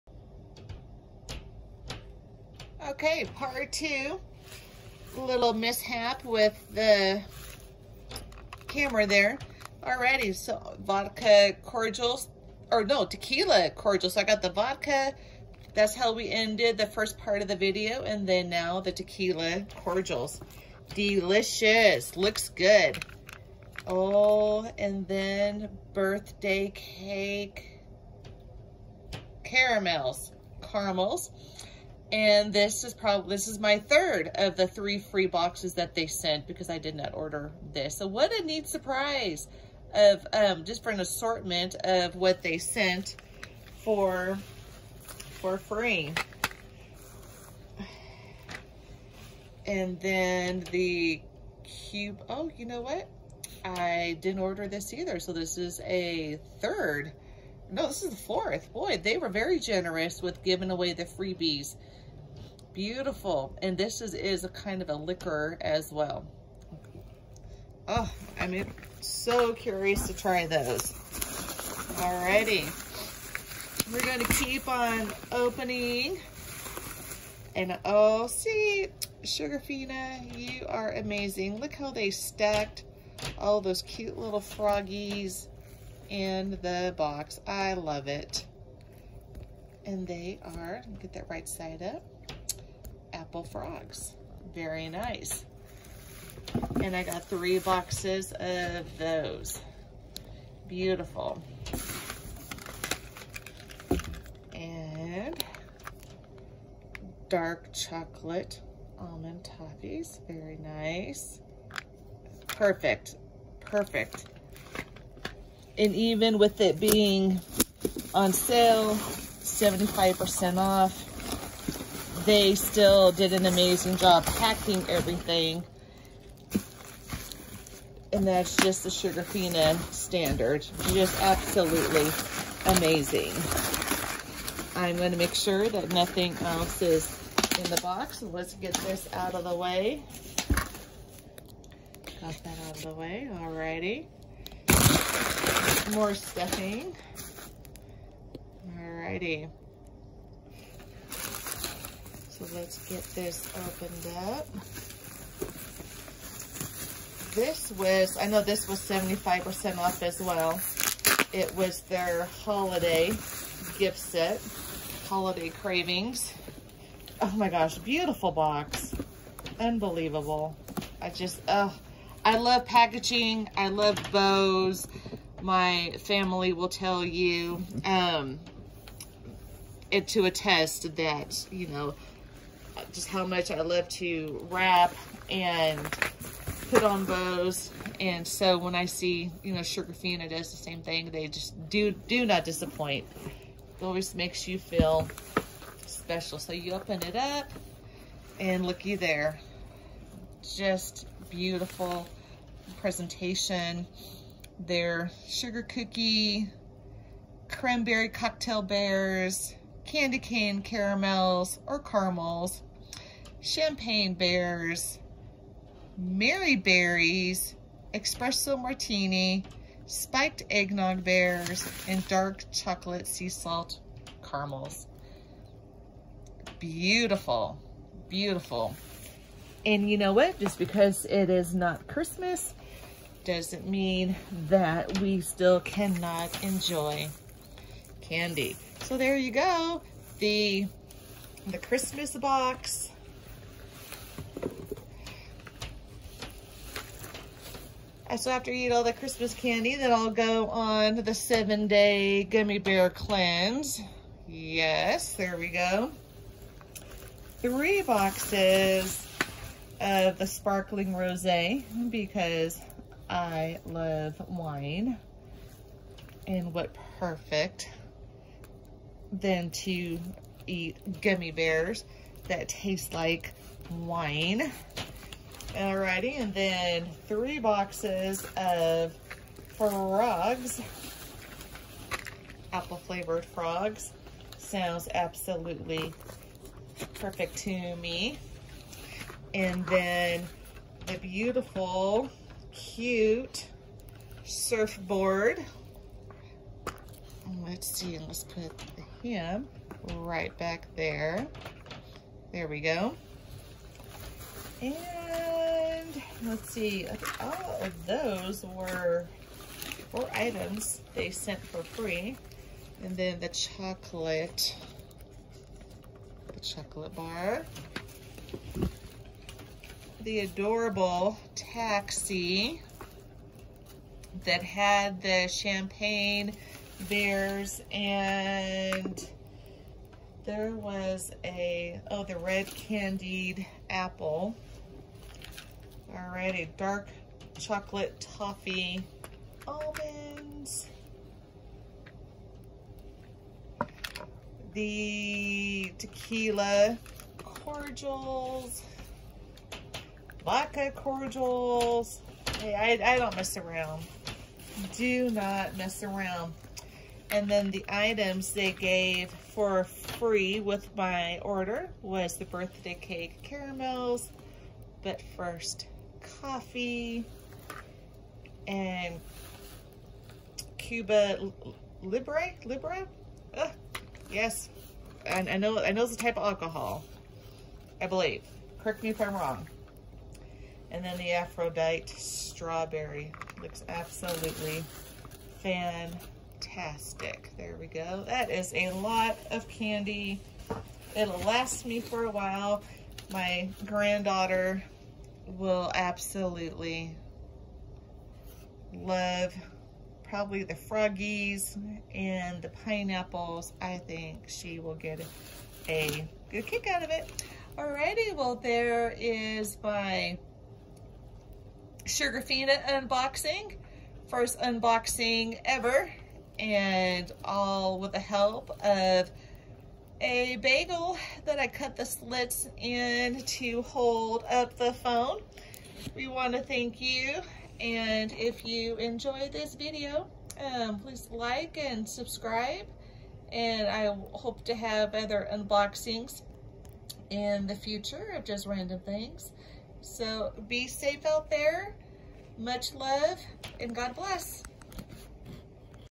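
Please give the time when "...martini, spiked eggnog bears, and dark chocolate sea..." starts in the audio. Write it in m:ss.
3:38.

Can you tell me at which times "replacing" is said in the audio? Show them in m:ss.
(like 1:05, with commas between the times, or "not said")
not said.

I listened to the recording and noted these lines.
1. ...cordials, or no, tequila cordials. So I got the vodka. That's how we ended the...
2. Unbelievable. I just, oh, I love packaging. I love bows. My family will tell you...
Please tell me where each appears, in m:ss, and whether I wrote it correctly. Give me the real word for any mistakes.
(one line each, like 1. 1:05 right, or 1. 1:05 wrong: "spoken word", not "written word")
1. 0:11 right
2. 2:49 right.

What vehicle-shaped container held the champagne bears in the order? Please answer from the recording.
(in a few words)
Taxi.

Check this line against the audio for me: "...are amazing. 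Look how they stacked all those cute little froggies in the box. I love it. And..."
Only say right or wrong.
right.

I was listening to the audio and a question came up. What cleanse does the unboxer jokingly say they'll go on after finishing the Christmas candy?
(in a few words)
Seven day gummy bear cleanse.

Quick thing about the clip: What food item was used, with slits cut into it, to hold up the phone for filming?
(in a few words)
A bagel.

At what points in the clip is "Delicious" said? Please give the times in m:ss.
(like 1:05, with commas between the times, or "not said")
0:20.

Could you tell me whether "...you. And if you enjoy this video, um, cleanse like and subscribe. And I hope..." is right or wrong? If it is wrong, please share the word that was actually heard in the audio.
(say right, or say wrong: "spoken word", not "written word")
wrong: "please", not "cleanse".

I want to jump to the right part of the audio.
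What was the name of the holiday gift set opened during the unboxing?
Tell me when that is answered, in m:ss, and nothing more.
2:45.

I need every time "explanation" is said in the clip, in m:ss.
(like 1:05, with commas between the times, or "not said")
not said.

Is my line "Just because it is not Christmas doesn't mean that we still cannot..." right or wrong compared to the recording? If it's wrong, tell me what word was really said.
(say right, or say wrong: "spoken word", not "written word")
right.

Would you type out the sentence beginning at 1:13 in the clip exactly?
We're going to keep on opening.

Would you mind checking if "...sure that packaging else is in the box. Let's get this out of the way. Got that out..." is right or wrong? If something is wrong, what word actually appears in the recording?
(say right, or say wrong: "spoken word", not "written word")
wrong: "nothing", not "packaging".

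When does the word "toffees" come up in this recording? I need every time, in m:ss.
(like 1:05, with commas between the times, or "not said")
1:49, 5:37.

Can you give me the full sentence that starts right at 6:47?
Alrighty, well there is my Sugarfina unboxing.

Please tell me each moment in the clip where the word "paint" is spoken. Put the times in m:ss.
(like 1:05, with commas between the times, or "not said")
not said.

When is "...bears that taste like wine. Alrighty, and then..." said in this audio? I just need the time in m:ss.
4:31.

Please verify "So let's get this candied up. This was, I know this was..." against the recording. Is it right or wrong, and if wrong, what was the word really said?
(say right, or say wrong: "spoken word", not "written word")
wrong: "opened", not "candied".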